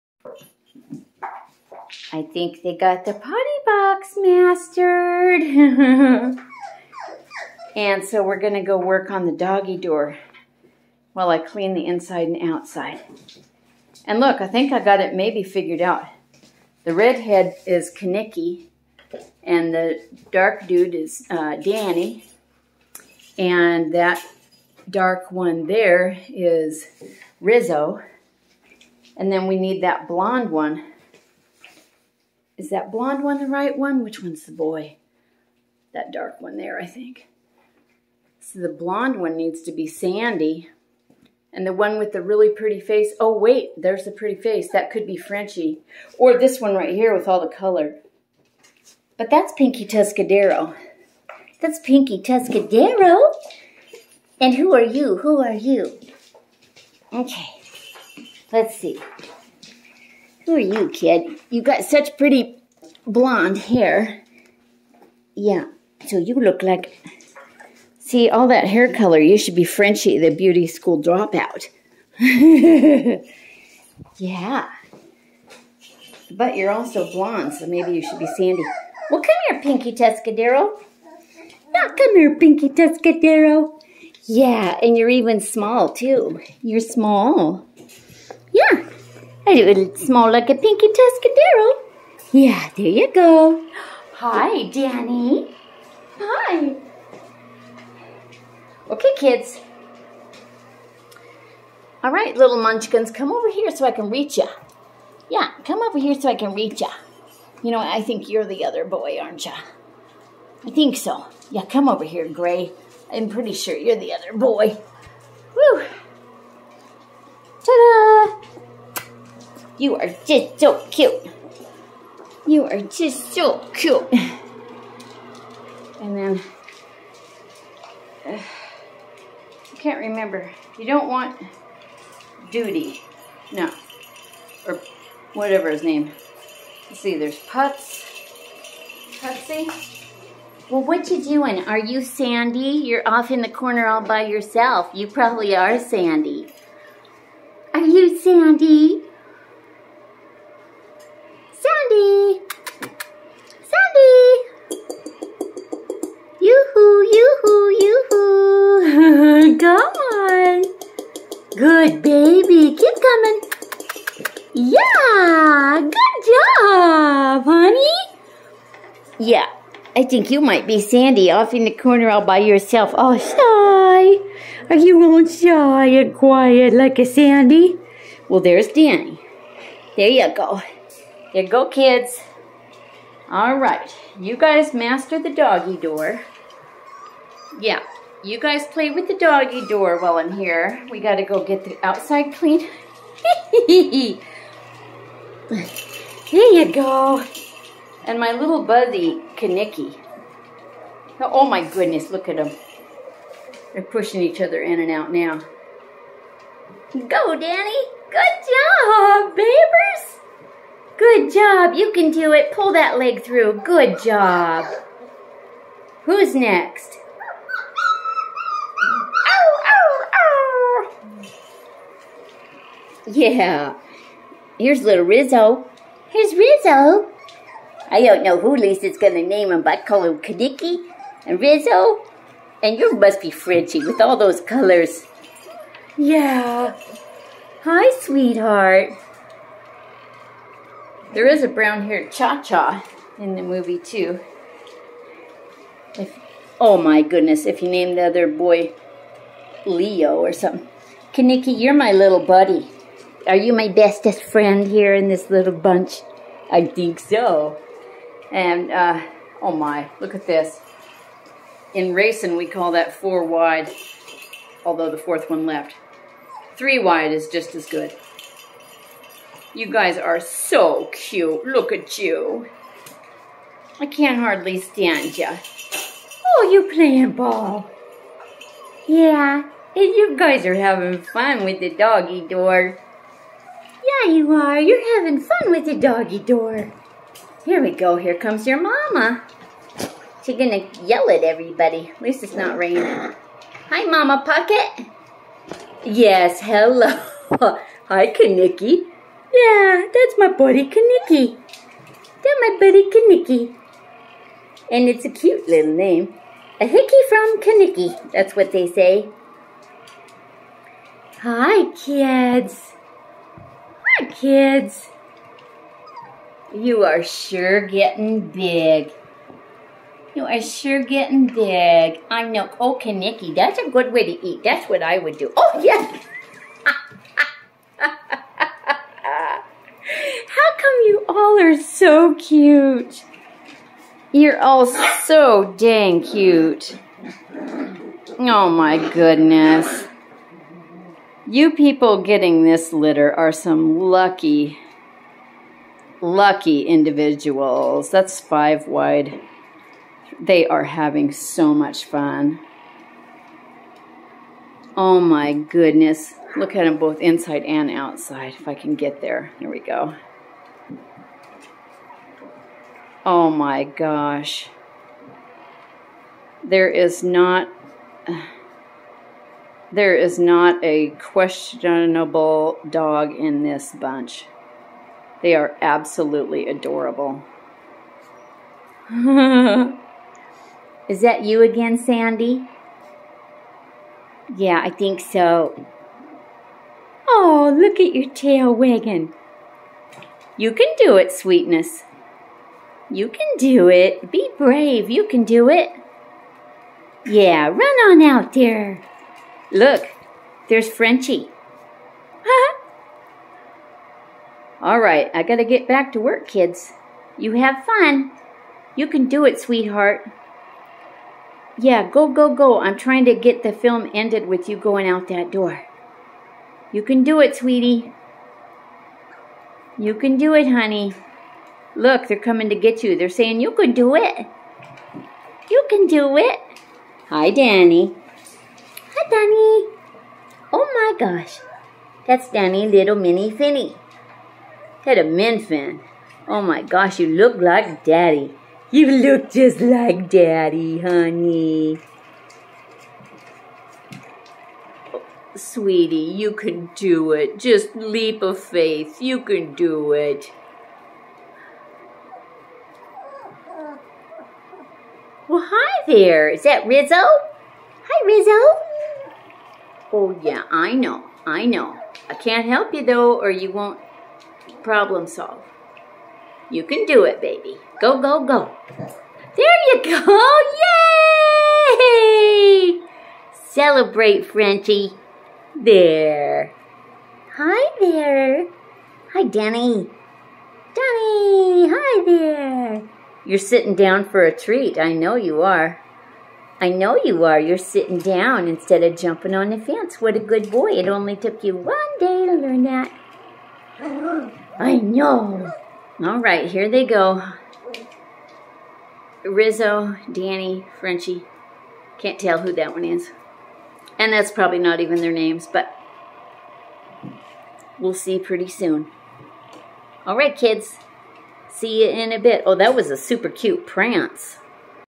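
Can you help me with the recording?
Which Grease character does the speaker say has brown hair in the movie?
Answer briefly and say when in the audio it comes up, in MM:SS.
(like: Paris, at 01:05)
Cha-Cha, at 04:02.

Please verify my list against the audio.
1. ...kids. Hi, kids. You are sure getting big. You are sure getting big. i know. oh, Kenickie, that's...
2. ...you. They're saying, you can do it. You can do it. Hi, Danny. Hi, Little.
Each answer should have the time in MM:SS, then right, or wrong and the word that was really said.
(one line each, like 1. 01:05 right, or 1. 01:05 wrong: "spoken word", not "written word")
1. 05:11 right
2. 07:02 wrong: "Danny", not "Little".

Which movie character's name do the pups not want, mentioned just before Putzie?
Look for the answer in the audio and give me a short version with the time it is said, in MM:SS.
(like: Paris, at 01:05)
Doody, at 02:12.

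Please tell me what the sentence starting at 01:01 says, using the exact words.
You got such pretty blonde hair.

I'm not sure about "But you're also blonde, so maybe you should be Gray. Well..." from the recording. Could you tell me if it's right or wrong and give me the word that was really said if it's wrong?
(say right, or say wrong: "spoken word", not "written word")
wrong: "Sandy", not "Gray".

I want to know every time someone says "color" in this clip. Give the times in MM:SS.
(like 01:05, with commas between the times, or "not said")
00:47, 01:08, 03:54.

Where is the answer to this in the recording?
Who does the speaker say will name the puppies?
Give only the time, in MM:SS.
03:48.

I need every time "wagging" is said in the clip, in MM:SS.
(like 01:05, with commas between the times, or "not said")
06:28.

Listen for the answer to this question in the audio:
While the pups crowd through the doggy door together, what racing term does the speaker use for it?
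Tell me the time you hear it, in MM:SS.
04:22.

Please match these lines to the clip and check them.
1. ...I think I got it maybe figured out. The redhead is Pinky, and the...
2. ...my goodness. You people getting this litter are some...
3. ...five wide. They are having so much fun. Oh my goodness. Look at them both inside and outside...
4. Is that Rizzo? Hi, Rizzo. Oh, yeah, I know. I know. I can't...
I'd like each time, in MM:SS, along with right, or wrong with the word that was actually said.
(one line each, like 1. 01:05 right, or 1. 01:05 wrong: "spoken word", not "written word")
1. 00:14 wrong: "Kenickie", not "Pinky"
2. 05:38 right
3. 05:48 right
4. 07:36 right.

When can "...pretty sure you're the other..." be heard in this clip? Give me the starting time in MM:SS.
01:53.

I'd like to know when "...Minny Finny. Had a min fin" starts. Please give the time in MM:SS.
07:12.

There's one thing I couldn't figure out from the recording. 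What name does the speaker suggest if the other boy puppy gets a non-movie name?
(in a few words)
Leo.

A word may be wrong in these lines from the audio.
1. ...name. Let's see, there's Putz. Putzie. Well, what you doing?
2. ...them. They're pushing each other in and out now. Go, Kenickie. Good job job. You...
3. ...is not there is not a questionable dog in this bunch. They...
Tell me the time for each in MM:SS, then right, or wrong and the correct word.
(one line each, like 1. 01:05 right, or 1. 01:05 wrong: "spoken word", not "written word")
1. 02:15 right
2. 03:22 wrong: "Danny", not "Kenickie"
3. 06:06 right.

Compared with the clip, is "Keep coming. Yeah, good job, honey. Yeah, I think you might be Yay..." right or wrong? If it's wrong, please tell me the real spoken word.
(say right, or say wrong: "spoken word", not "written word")
wrong: "Sandy", not "Yay".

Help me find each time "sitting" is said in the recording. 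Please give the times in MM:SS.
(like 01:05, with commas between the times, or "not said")
08:03, 08:07.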